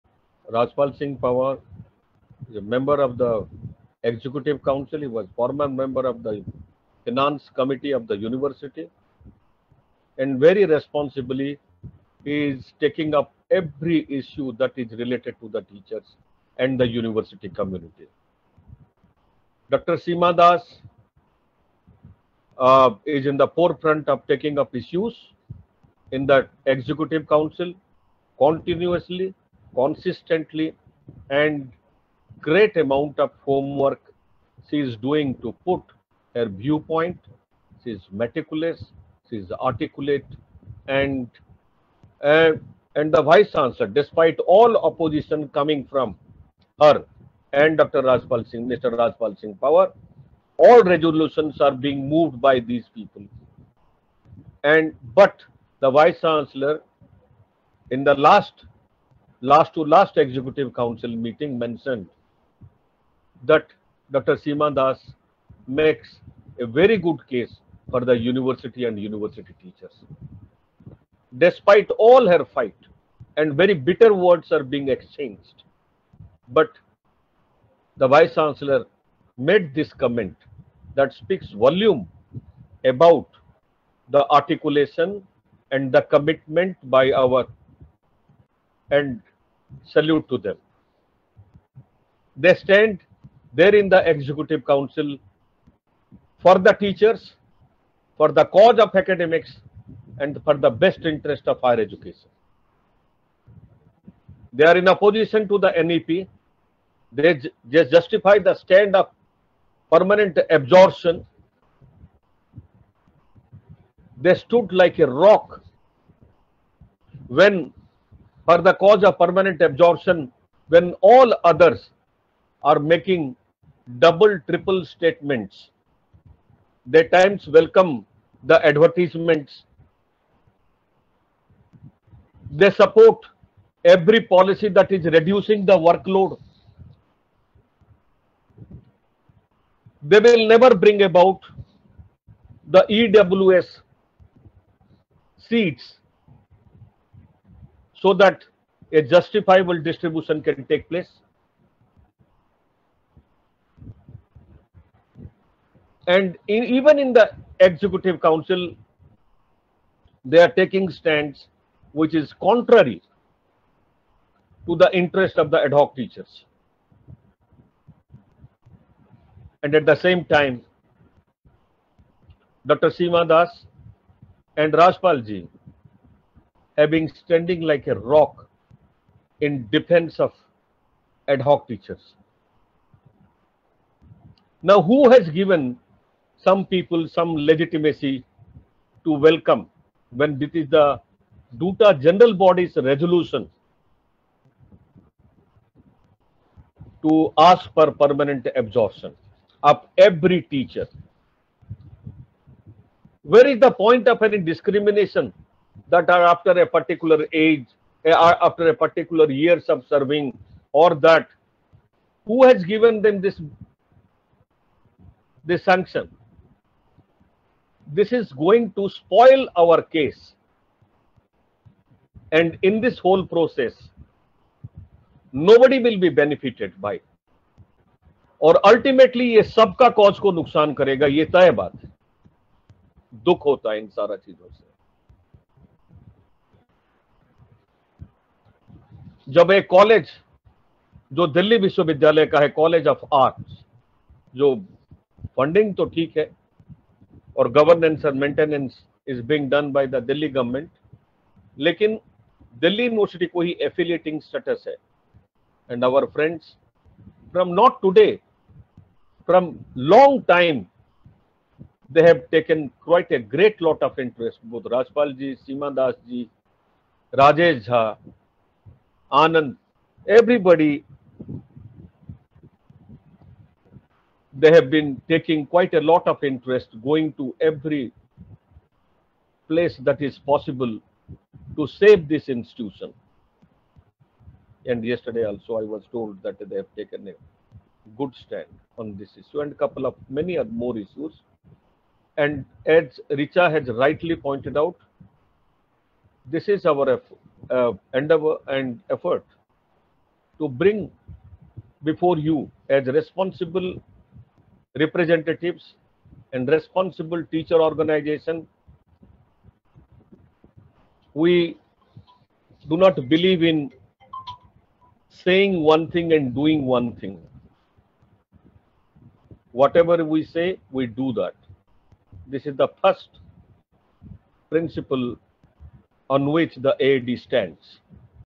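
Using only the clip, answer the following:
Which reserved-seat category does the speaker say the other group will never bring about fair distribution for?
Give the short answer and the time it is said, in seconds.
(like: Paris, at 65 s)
EWS, at 142 s.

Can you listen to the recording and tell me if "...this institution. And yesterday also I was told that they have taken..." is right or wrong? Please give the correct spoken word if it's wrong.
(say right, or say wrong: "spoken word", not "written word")
right.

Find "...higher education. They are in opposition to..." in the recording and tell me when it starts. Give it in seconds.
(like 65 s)
101 s.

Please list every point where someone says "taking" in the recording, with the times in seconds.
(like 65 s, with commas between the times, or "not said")
12 s, 24 s, 160 s, 275 s.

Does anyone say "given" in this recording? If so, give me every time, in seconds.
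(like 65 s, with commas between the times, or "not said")
185 s, 212 s.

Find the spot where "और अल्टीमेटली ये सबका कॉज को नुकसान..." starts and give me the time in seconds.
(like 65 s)
228 s.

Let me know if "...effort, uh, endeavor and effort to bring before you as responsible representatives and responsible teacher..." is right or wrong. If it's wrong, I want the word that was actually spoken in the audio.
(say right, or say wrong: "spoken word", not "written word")
right.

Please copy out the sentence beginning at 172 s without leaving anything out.
Seema Das and Rajpal Ji have been standing like a rock in defense of ad hoc teachers.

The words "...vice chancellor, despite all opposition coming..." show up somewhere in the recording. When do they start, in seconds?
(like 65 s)
43 s.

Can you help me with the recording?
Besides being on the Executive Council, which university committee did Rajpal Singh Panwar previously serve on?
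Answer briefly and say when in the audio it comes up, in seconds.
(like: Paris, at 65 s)
Finance Committee, at 7 s.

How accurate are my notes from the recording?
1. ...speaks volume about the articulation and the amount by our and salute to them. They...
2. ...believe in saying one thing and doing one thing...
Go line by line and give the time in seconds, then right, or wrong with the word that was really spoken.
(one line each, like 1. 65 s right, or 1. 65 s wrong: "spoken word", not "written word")
1. 81 s wrong: "commitment", not "amount"
2. 313 s right.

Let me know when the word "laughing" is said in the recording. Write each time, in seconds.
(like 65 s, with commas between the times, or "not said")
not said.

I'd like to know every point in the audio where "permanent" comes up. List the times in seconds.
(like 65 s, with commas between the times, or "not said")
109 s, 119 s, 197 s.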